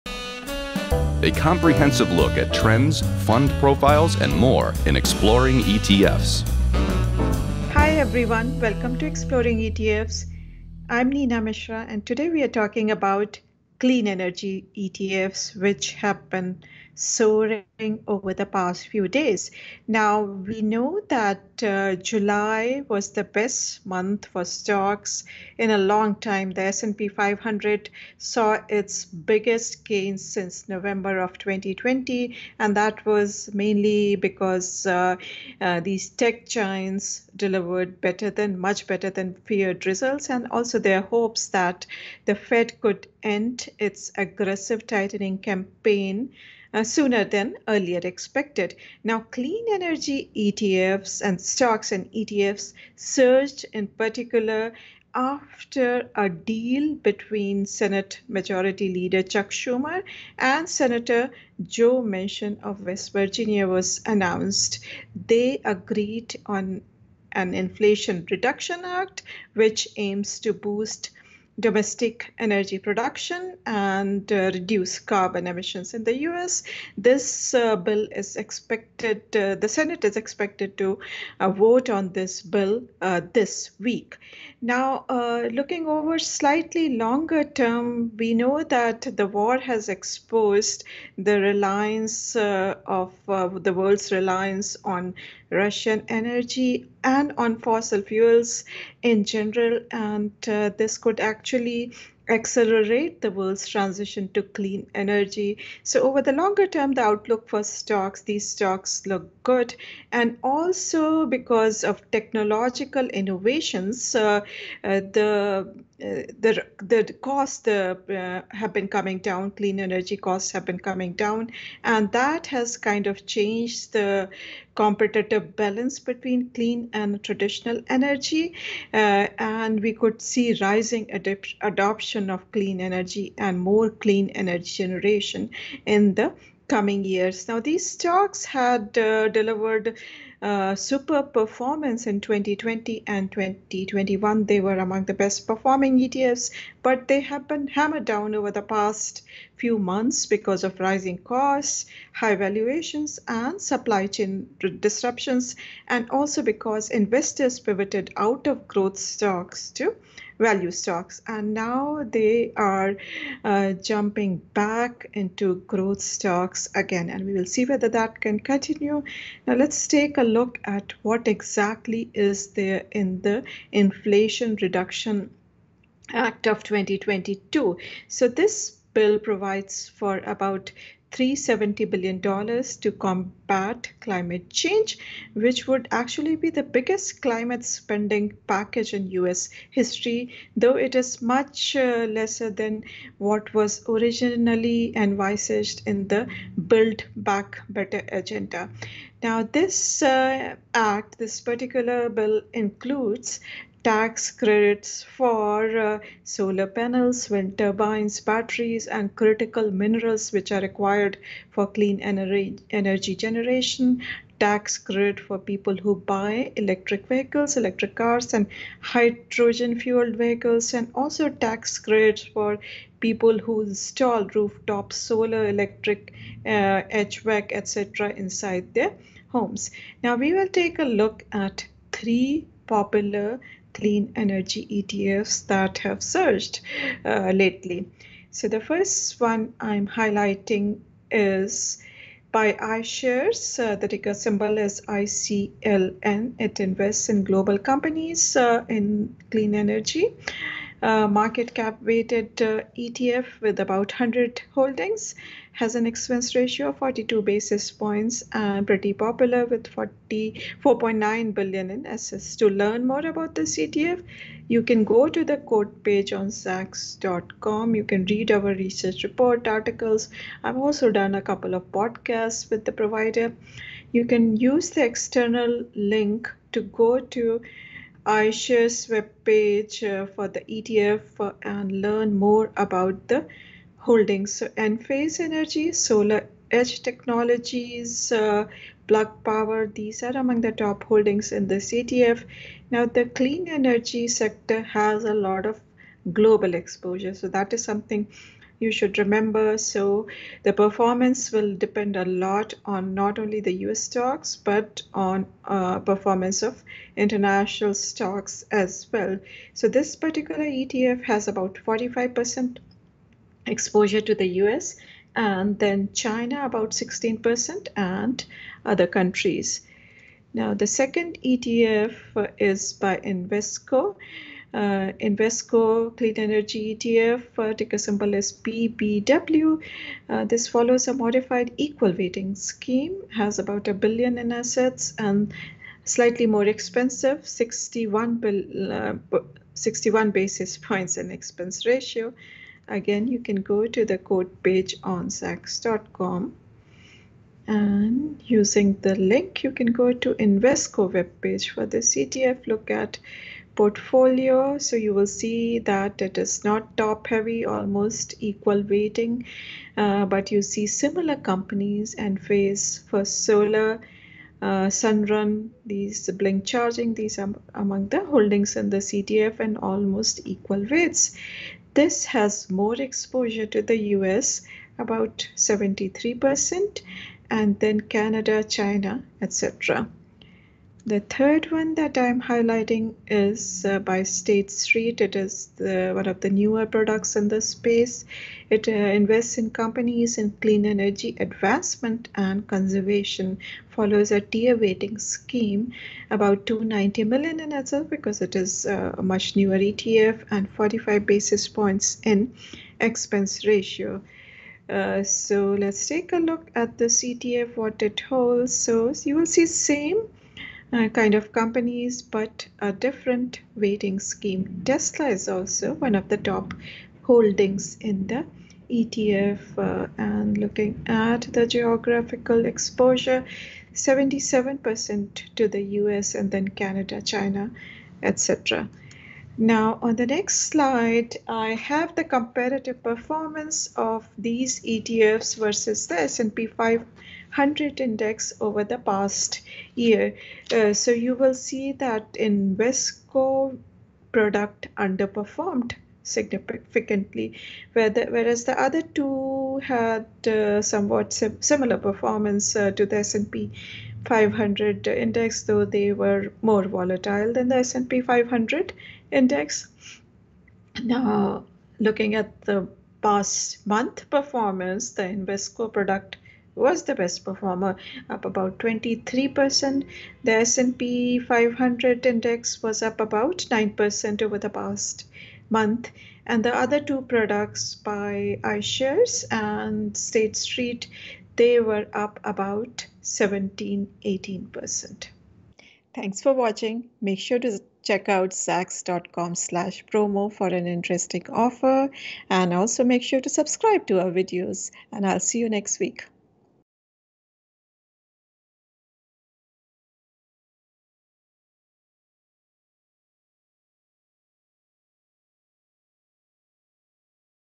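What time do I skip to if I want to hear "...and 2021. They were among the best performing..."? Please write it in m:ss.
2:23.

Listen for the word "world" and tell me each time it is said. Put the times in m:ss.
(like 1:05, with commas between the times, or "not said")
1:33, 1:43.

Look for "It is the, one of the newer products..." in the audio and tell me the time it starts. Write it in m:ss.
6:24.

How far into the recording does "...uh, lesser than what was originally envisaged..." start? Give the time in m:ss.
3:11.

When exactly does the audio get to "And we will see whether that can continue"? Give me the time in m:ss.
2:47.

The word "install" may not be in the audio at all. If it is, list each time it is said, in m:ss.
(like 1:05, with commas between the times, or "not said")
3:43.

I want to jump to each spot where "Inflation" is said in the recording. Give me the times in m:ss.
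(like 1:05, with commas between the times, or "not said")
1:07, 2:53.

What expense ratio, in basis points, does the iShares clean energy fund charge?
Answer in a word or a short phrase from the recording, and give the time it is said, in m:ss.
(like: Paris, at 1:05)
42 basis points, at 4:16.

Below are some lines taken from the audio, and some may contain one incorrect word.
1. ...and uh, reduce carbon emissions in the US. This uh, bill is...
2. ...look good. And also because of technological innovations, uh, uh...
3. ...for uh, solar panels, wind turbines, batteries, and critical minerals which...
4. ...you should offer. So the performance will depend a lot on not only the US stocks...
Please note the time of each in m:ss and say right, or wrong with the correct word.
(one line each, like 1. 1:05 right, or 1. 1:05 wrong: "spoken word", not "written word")
1. 1:13 right
2. 1:49 right
3. 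3:25 right
4. 4:58 wrong: "remember", not "offer".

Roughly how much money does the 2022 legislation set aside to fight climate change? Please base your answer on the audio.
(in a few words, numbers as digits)
$370 billion.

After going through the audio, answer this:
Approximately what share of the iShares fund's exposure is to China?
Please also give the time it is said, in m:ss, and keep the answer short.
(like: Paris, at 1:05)
16%, at 5:16.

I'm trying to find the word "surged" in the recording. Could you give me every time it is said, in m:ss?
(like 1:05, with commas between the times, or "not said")
0:52, 3:56.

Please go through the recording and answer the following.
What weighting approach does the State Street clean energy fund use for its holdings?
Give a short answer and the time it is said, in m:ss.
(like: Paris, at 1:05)
tier weighting, at 6:34.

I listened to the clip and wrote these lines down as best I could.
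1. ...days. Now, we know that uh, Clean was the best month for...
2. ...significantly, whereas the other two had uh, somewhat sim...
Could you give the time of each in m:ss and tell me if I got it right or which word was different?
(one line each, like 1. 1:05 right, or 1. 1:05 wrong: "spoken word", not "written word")
1. 0:19 wrong: "July", not "Clean"
2. 7:26 right.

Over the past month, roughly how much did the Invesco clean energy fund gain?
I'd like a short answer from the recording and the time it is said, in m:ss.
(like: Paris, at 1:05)
23%, at 7:48.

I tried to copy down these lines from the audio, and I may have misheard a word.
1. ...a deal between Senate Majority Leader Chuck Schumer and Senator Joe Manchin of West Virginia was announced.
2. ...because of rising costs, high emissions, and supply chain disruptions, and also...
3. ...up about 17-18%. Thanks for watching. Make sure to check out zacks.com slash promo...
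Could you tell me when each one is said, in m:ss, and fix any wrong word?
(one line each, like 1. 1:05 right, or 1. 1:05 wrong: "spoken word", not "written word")
1. 0:56 right
2. 2:30 wrong: "valuations", not "emissions"
3. 8:01 right.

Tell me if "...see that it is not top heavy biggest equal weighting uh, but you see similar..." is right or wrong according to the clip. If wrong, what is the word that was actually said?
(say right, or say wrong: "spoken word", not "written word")
wrong: "almost", not "biggest".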